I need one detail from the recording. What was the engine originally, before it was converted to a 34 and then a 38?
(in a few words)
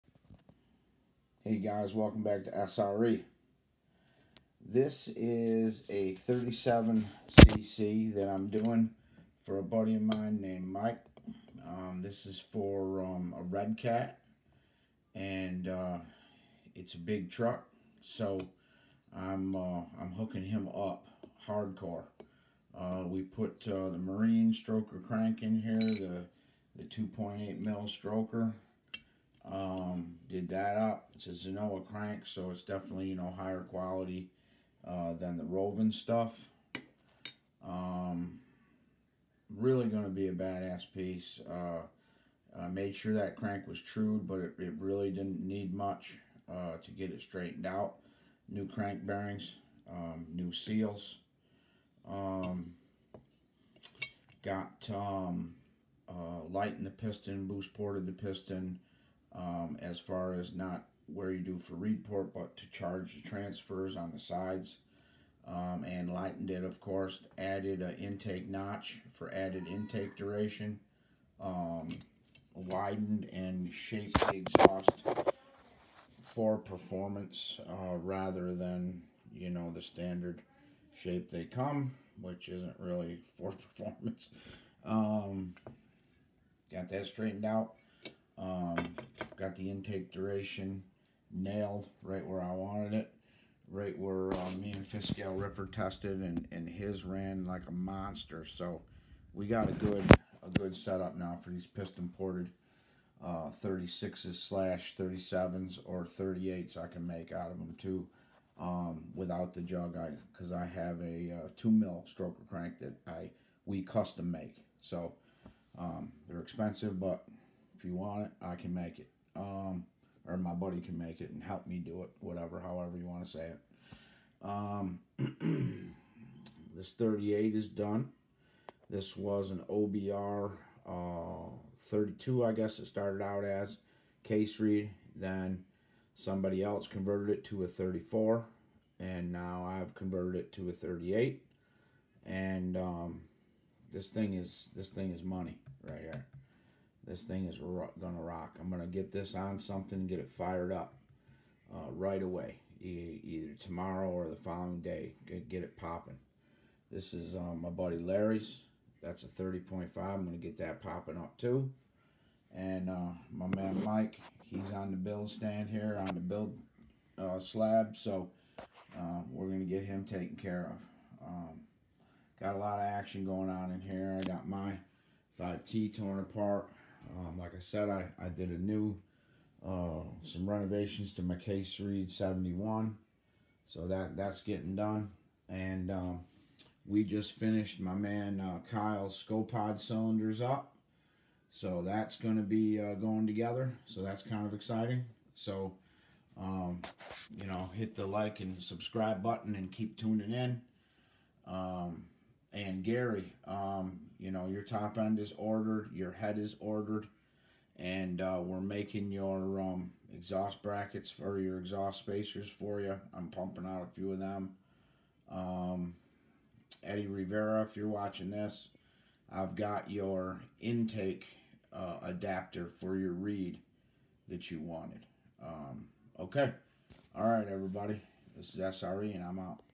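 OBR 32.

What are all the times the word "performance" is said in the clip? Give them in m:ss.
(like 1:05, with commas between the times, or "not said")
1:16, 1:23.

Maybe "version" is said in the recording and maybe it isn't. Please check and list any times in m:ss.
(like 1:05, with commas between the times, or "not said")
not said.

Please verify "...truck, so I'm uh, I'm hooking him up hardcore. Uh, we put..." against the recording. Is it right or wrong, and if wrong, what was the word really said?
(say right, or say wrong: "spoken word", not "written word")
right.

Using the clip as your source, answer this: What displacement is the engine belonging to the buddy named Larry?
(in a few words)
30.5.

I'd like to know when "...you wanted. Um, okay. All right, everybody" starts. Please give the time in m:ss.
3:44.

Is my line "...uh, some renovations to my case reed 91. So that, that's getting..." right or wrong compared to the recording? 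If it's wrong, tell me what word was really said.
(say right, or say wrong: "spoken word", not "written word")
wrong: "71", not "91".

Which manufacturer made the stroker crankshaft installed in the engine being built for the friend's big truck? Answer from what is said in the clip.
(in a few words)
Zenoah.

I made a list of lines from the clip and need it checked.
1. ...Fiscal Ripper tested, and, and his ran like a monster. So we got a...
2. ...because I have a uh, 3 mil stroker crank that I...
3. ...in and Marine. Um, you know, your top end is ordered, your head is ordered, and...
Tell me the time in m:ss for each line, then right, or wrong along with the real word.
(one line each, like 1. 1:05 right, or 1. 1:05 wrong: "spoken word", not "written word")
1. 1:34 right
2. 1:50 wrong: "2", not "3"
3. 3:20 wrong: "Gary", not "Marine".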